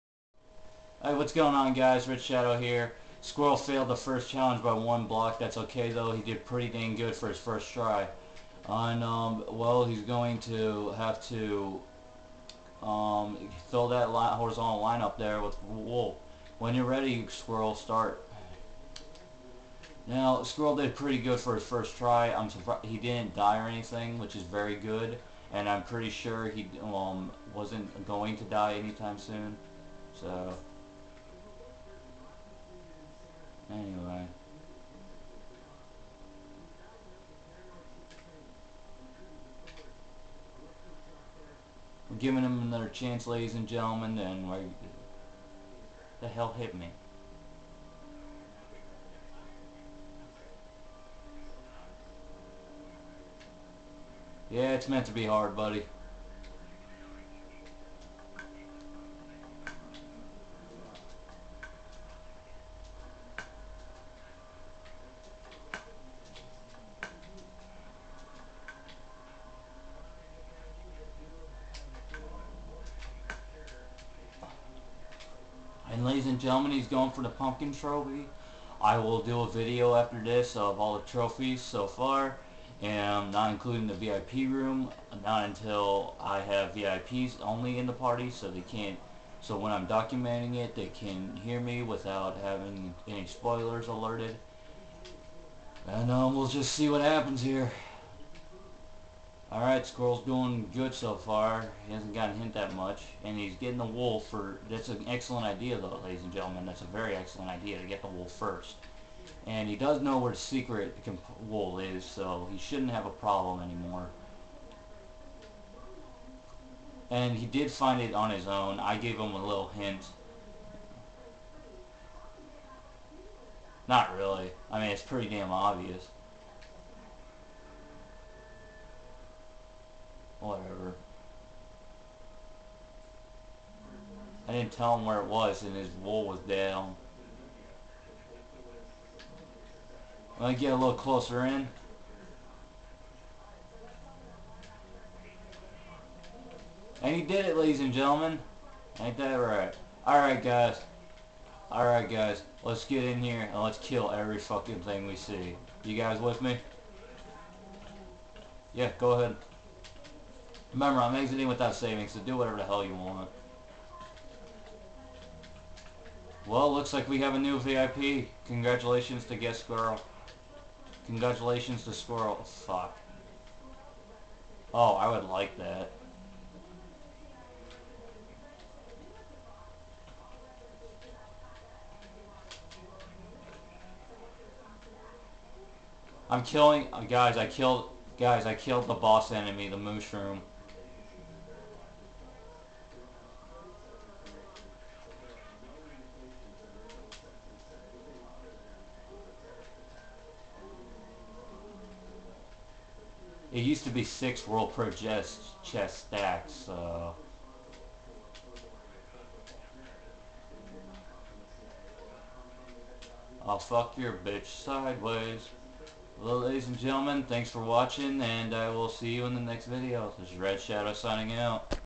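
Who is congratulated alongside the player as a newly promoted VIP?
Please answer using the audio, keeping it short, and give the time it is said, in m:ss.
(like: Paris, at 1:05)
Guest Girl, at 2:49.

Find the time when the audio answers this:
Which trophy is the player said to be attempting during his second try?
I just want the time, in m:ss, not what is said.
1:17.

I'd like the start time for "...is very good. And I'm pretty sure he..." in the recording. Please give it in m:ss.
0:24.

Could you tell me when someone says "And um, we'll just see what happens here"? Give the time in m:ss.
1:35.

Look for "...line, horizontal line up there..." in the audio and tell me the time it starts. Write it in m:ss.
0:14.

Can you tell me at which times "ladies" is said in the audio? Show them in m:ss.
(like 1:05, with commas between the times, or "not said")
0:43, 1:16, 1:46, 2:27, 3:36.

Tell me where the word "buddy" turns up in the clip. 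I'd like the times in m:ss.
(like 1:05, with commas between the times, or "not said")
0:55.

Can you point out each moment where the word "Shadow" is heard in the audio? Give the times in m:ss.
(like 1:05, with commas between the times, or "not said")
0:02, 3:40.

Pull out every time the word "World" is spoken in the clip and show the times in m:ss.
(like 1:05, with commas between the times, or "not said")
3:24.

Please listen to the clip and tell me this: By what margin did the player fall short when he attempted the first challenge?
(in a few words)
1 block.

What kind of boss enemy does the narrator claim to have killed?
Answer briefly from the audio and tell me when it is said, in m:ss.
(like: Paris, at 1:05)
mushroom, at 3:09.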